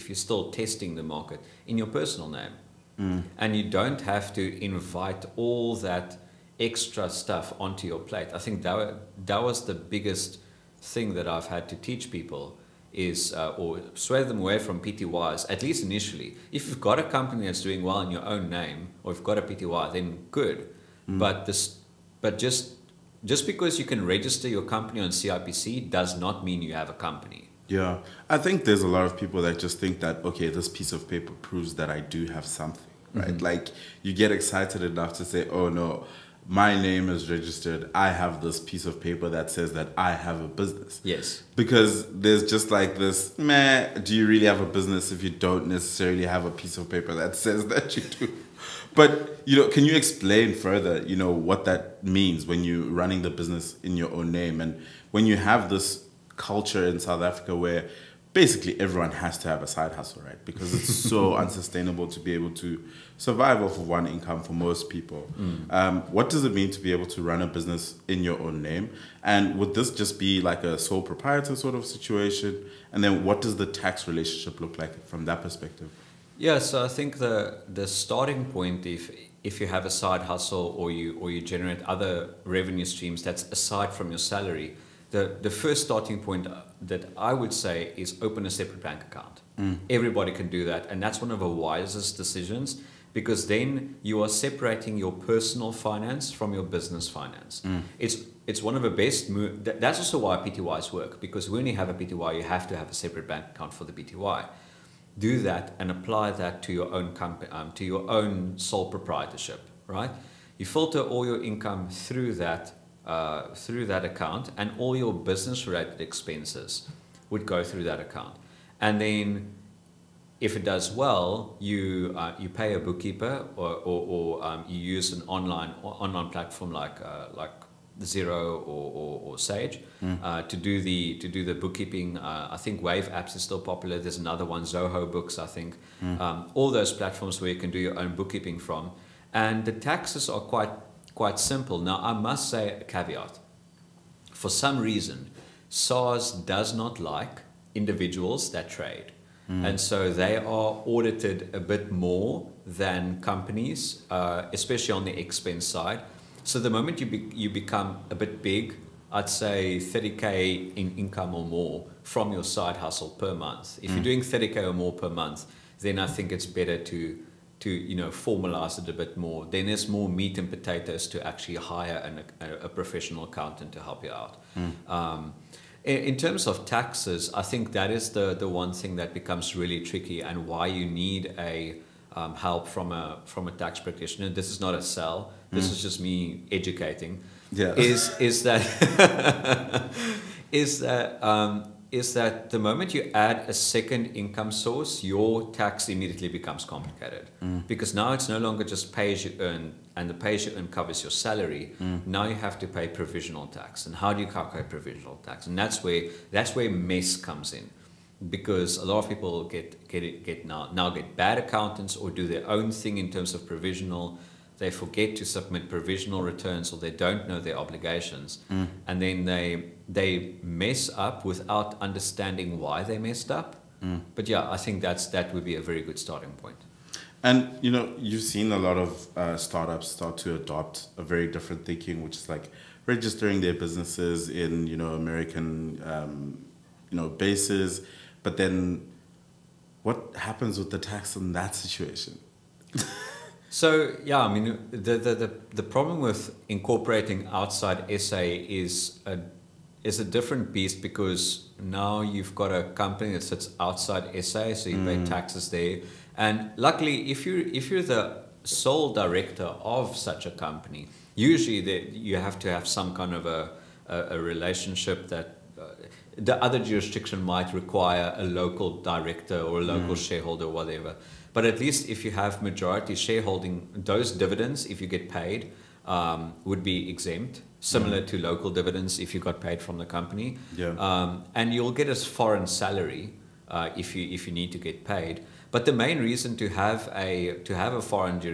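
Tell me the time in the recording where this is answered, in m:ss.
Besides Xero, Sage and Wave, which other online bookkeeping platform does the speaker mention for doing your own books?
2:14.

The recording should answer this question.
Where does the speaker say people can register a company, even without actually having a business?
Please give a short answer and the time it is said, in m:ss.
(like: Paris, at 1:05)
CIPC, at 0:25.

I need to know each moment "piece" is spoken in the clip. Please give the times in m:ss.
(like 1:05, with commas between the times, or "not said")
0:30, 0:38, 0:46.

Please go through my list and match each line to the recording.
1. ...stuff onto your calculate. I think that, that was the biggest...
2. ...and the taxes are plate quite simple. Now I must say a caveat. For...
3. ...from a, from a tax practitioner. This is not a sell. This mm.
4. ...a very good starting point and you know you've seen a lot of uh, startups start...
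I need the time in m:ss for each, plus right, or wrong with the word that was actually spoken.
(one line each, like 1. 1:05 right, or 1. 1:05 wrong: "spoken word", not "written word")
1. 0:07 wrong: "plate", not "calculate"
2. 2:19 wrong: "quite", not "plate"
3. 3:02 right
4. 3:45 right.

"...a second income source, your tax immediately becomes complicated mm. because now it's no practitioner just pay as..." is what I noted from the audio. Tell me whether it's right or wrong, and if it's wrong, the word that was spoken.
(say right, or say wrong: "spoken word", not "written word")
wrong: "longer", not "practitioner".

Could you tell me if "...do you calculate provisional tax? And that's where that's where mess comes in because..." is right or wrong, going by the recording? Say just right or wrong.
right.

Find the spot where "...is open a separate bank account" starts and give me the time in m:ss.
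1:27.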